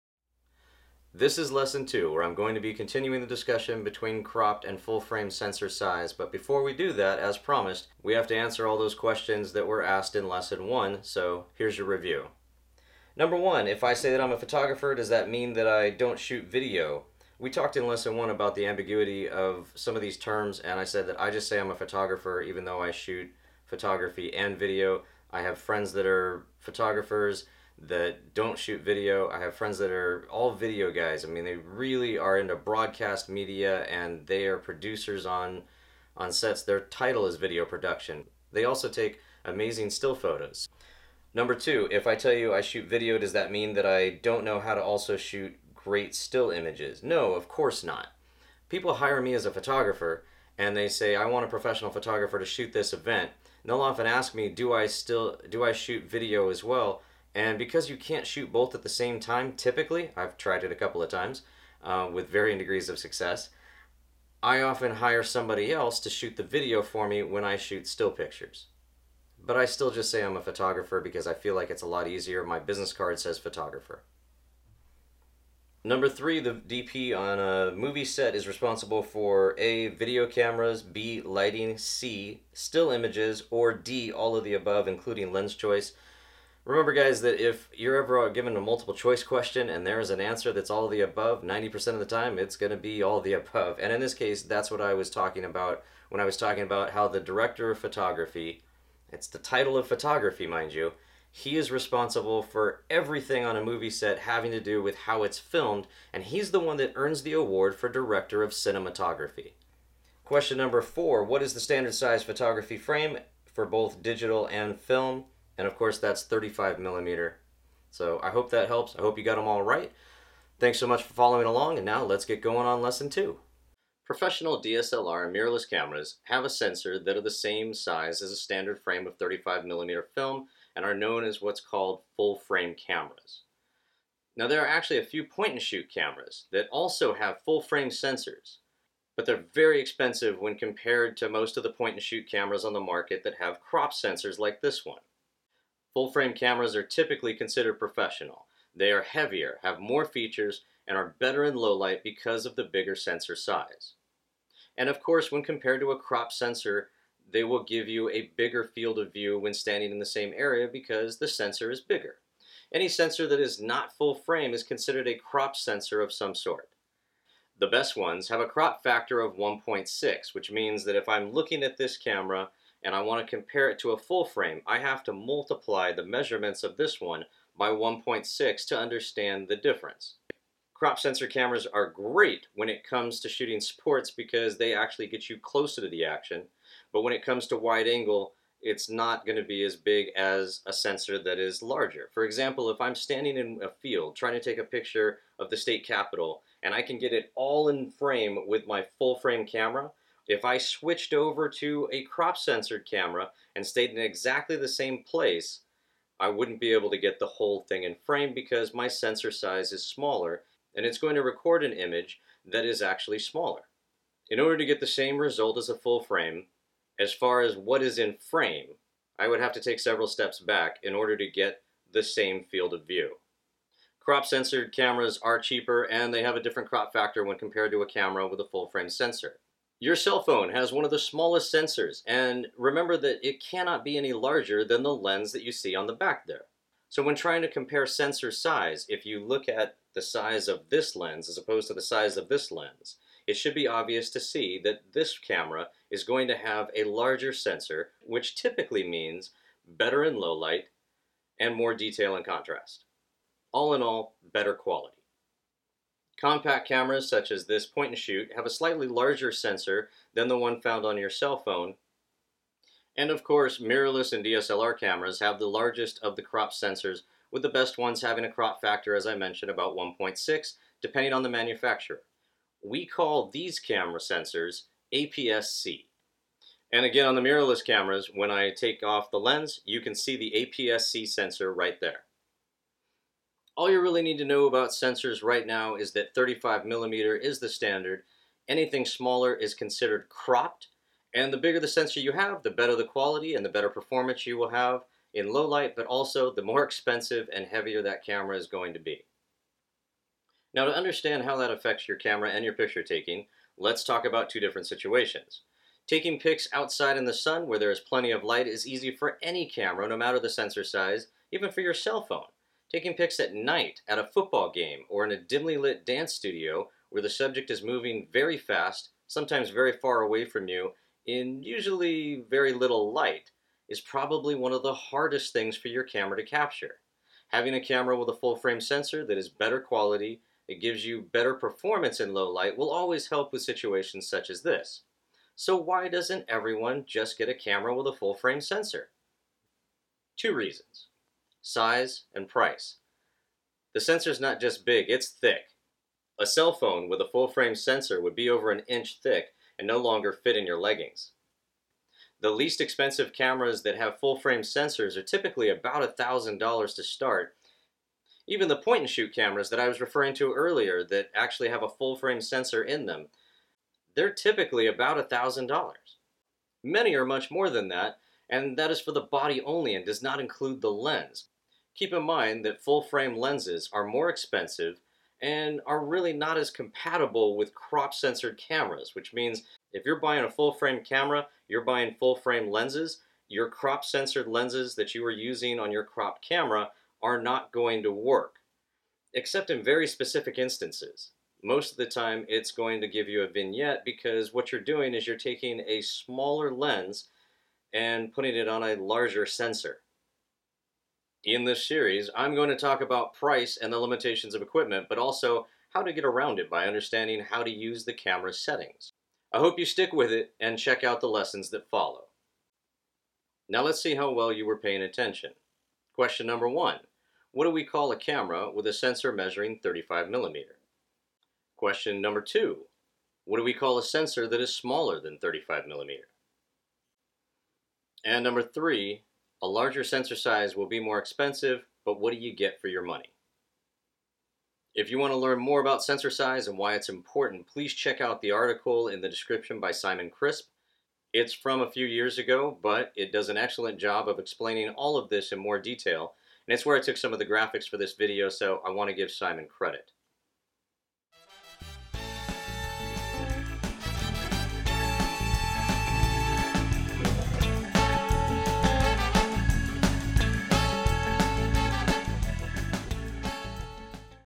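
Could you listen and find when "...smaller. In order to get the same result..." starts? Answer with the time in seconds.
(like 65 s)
213 s.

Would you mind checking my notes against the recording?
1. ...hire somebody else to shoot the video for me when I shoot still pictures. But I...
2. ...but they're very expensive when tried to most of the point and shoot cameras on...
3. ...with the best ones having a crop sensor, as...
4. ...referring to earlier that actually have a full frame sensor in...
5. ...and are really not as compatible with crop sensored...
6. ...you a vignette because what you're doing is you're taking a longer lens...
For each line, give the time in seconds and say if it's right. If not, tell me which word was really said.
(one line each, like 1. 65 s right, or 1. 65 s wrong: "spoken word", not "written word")
1. 64 s right
2. 139 s wrong: "compared", not "tried"
3. 267 s wrong: "factor", not "sensor"
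4. 359 s right
5. 375 s right
6. 393 s wrong: "smaller", not "longer".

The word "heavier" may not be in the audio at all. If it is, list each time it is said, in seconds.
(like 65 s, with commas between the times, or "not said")
149 s, 297 s.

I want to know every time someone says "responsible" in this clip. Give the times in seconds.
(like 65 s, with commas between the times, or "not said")
78 s, 101 s.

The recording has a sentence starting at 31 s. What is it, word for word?
I mean, they really are into broadcast media and they are producers on on sets.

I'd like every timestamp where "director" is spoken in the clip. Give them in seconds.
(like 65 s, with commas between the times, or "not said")
97 s, 107 s.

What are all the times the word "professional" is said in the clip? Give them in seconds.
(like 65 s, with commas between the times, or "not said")
51 s, 124 s, 147 s.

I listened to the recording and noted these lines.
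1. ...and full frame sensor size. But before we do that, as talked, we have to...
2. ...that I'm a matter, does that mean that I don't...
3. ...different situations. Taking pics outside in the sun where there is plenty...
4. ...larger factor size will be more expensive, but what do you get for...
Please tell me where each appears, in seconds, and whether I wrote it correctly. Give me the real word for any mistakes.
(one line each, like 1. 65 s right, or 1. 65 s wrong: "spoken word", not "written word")
1. 4 s wrong: "promised", not "talked"
2. 14 s wrong: "photographer", not "matter"
3. 304 s right
4. 429 s wrong: "sensor", not "factor".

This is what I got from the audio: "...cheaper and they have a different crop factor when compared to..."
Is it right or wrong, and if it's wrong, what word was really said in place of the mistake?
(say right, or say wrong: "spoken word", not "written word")
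right.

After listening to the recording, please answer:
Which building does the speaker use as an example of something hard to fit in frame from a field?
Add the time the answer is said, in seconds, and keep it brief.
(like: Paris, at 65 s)
the state capitol, at 195 s.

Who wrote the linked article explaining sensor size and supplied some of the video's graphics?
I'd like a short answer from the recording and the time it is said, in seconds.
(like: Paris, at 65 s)
Simon Crisp, at 439 s.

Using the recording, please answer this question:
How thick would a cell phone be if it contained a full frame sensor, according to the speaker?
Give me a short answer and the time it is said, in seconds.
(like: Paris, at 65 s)
over an inch, at 348 s.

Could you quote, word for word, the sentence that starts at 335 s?
So why doesn't everyone just get a camera with a full frame sensor?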